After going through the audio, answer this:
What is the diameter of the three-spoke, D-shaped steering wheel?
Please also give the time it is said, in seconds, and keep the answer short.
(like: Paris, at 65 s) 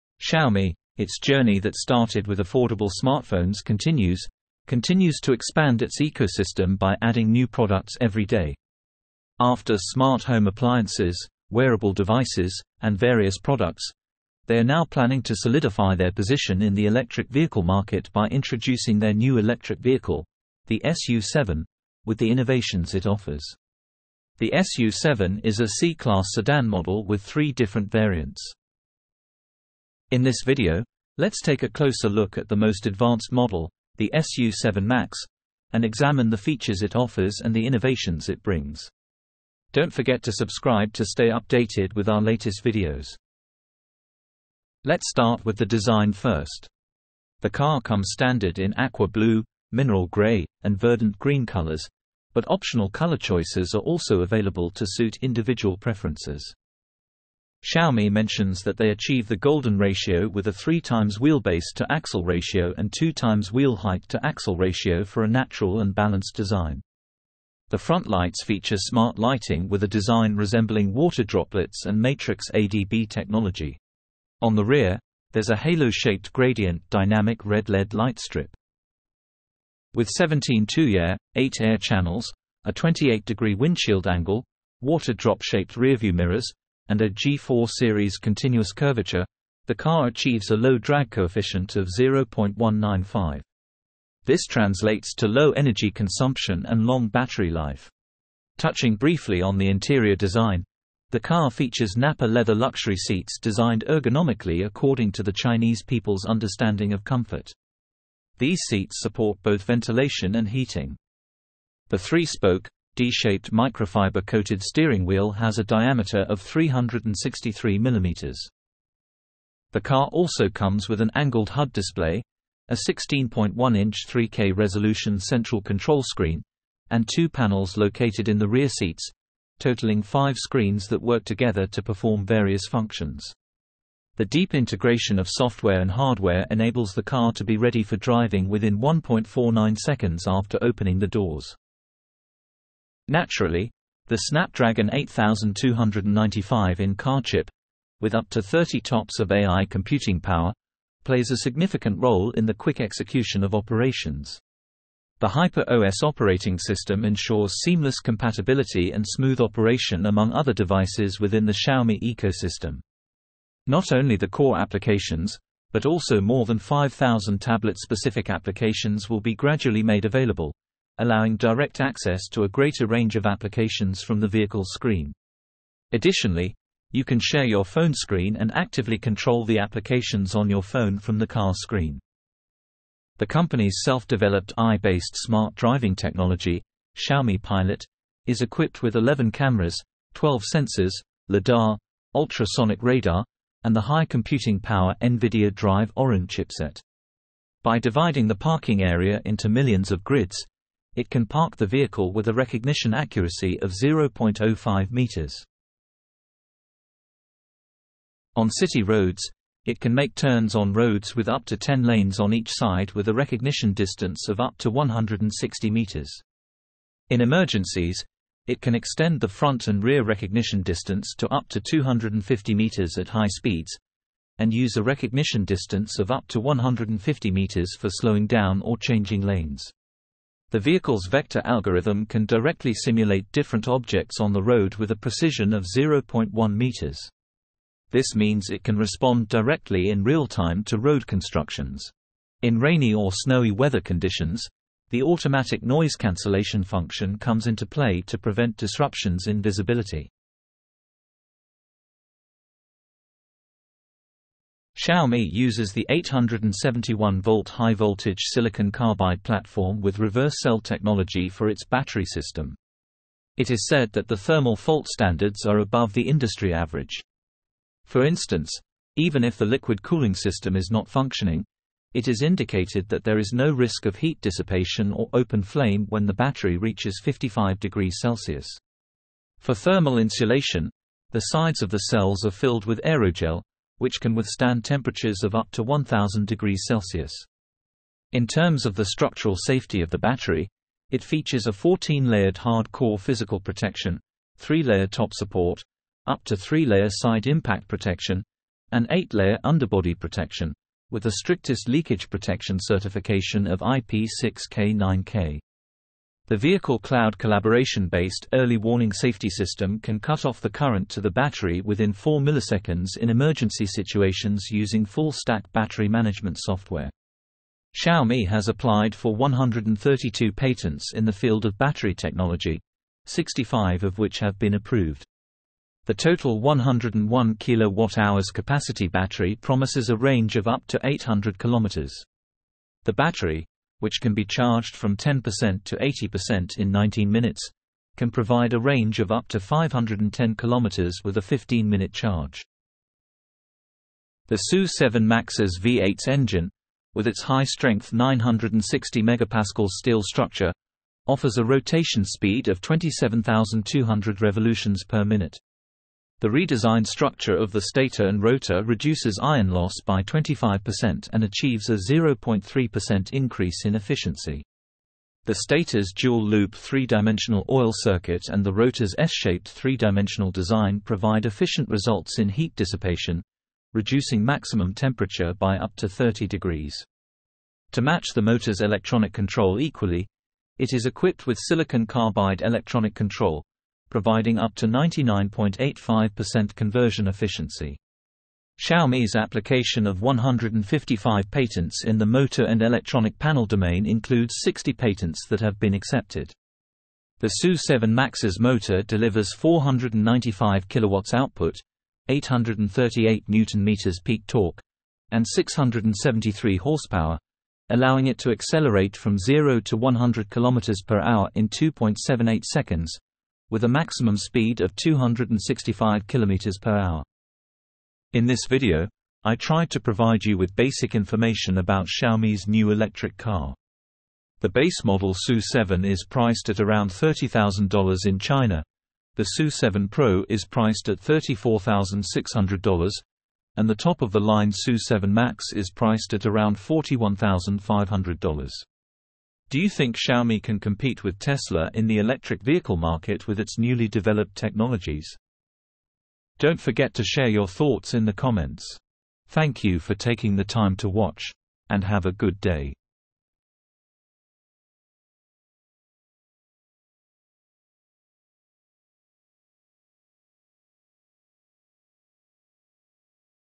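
363 mm, at 116 s.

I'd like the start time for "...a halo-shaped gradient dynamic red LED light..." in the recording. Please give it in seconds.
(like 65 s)
75 s.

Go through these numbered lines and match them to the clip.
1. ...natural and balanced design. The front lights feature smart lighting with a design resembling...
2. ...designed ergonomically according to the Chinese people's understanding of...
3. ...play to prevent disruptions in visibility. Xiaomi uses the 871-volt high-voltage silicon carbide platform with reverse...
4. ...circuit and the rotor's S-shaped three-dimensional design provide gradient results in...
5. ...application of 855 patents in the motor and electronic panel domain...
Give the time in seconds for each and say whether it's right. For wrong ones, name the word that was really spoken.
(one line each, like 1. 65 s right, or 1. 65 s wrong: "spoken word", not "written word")
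1. 65 s right
2. 103 s right
3. 247 s right
4. 367 s wrong: "efficient", not "gradient"
5. 389 s wrong: "155", not "855".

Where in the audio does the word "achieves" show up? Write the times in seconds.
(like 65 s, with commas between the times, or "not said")
58 s, 90 s, 361 s.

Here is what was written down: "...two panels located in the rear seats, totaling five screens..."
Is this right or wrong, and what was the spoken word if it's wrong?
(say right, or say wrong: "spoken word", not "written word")
right.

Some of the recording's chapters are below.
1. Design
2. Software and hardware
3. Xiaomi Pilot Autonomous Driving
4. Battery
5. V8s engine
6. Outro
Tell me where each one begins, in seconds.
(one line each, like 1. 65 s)
1. 44 s
2. 134 s
3. 183 s
4. 253 s
5. 343 s
6. 417 s.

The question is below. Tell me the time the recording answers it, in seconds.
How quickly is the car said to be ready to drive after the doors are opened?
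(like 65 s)
138 s.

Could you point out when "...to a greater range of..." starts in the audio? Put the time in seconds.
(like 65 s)
172 s.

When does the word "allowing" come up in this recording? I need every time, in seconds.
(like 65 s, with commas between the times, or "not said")
170 s, 407 s.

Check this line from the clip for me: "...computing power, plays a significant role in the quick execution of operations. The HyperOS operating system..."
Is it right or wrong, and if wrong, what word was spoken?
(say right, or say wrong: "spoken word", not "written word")
right.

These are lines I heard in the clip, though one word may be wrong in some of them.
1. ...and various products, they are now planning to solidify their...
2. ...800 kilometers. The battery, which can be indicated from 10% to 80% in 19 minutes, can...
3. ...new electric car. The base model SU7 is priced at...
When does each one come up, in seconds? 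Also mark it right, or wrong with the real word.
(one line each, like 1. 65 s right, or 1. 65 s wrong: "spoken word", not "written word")
1. 12 s right
2. 330 s wrong: "charged", not "indicated"
3. 422 s right.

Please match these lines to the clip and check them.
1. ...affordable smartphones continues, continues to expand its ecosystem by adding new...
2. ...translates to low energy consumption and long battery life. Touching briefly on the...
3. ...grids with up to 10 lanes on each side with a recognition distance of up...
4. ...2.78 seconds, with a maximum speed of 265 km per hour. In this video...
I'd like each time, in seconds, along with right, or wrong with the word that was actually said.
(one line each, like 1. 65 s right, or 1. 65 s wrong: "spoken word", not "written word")
1. 2 s right
2. 94 s right
3. 210 s wrong: "roads", not "grids"
4. 411 s right.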